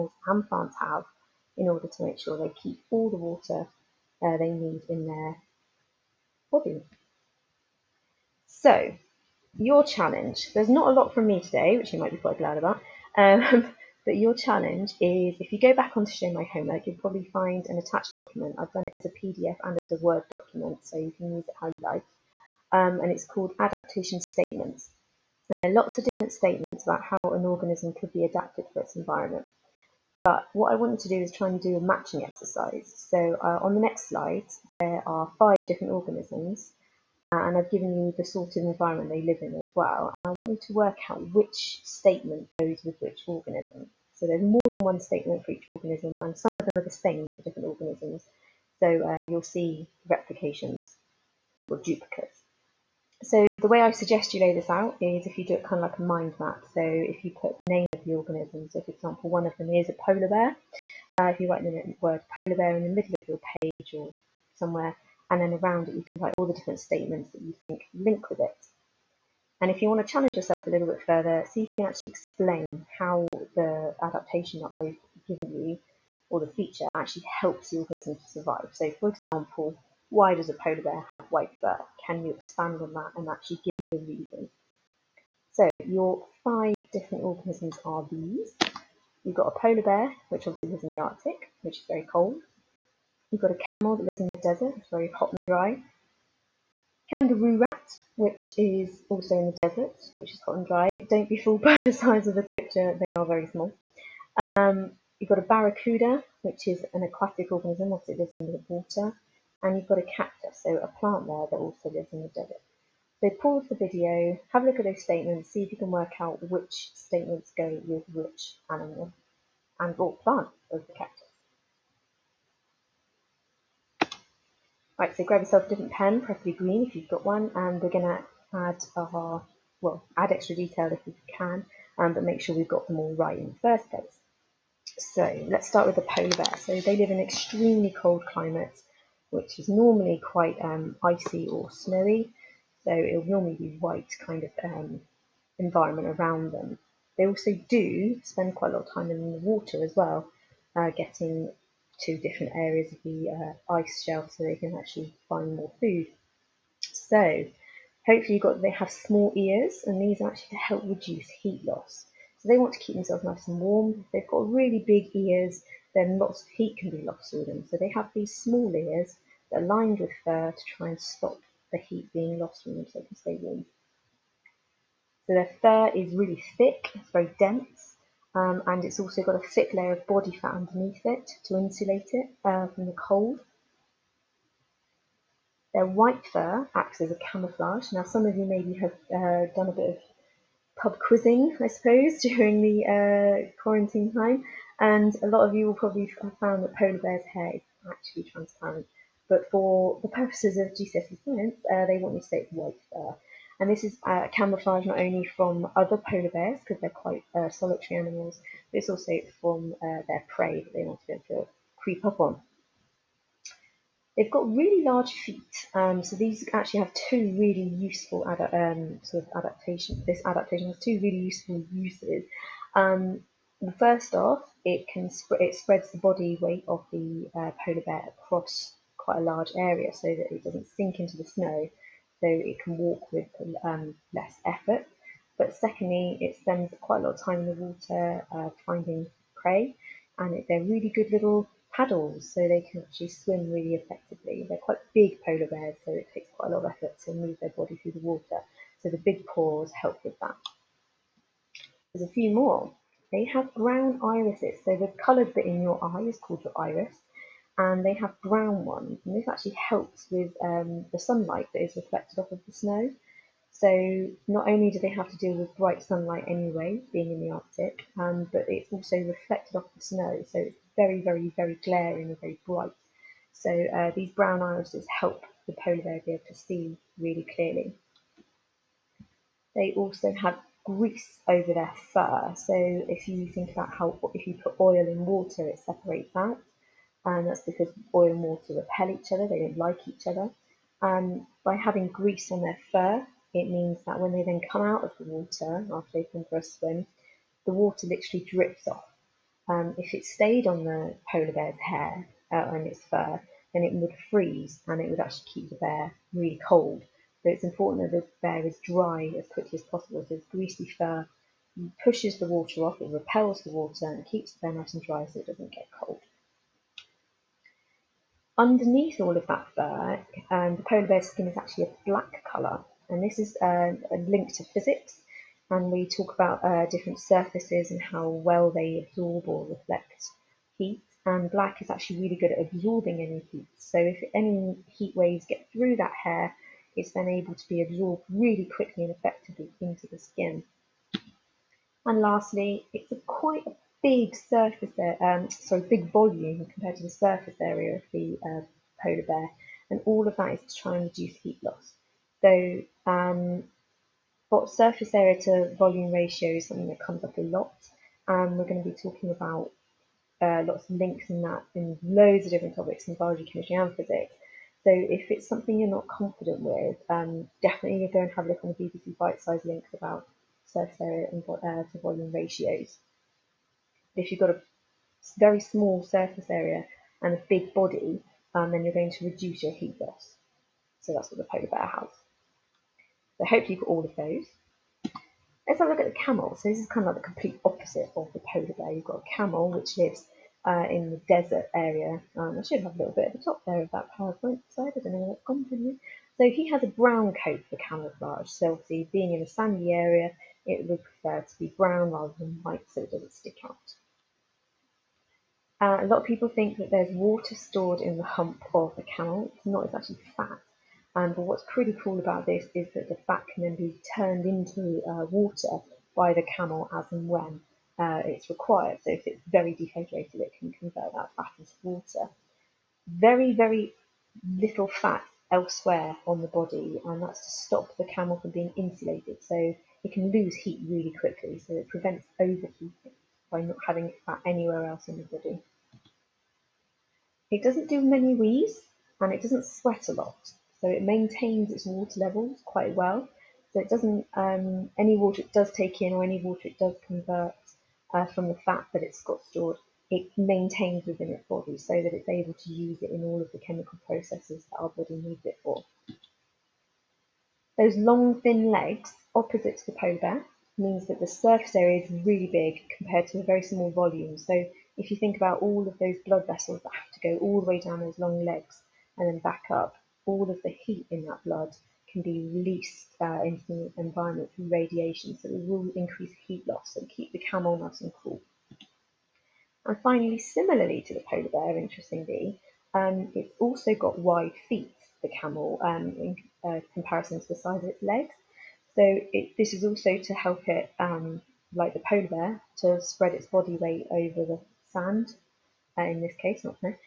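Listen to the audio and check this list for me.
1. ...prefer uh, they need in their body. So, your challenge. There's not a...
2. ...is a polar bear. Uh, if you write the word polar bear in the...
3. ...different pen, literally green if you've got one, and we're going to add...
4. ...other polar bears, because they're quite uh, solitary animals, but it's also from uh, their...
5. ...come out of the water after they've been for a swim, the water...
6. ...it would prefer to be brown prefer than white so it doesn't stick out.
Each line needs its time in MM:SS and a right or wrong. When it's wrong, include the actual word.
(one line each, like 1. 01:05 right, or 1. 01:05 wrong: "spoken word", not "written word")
1. 00:03 wrong: "water", not "prefer"
2. 00:59 right
3. 02:05 wrong: "preferably", not "literally"
4. 03:25 right
5. 04:54 right
6. 06:40 wrong: "rather", not "prefer".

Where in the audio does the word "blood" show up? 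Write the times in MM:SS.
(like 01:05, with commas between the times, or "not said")
07:46, 07:51.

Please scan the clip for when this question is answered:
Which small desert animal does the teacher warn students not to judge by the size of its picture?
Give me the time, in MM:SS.
01:37.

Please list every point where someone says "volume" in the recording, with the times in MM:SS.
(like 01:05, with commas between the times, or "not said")
05:45, 05:55, 06:11, 07:43.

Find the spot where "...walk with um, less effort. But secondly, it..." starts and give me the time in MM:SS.
03:52.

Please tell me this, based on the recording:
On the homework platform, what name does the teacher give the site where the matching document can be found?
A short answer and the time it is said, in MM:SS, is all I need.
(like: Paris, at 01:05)
Show My Homework, at 00:16.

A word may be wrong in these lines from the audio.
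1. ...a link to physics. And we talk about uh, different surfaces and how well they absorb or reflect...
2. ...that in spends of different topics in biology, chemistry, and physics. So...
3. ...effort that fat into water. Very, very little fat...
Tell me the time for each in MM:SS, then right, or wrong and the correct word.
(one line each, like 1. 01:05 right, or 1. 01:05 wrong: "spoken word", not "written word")
1. 05:23 right
2. 06:01 wrong: "loads", not "spends"
3. 07:00 wrong: "convert", not "effort".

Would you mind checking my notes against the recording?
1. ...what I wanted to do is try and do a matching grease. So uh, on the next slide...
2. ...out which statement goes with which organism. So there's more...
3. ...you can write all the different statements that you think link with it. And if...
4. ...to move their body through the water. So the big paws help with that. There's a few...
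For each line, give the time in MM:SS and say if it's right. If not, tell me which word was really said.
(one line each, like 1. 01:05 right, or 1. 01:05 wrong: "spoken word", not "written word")
1. 00:30 wrong: "exercise", not "grease"
2. 00:41 right
3. 01:05 right
4. 04:07 right.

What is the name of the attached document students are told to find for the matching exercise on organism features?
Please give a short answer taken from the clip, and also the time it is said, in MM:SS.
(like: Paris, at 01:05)
Adaptation Statements, at 00:23.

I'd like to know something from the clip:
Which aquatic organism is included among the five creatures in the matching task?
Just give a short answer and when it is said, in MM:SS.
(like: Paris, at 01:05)
barracuda, at 01:45.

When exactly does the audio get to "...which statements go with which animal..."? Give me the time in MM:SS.
01:56.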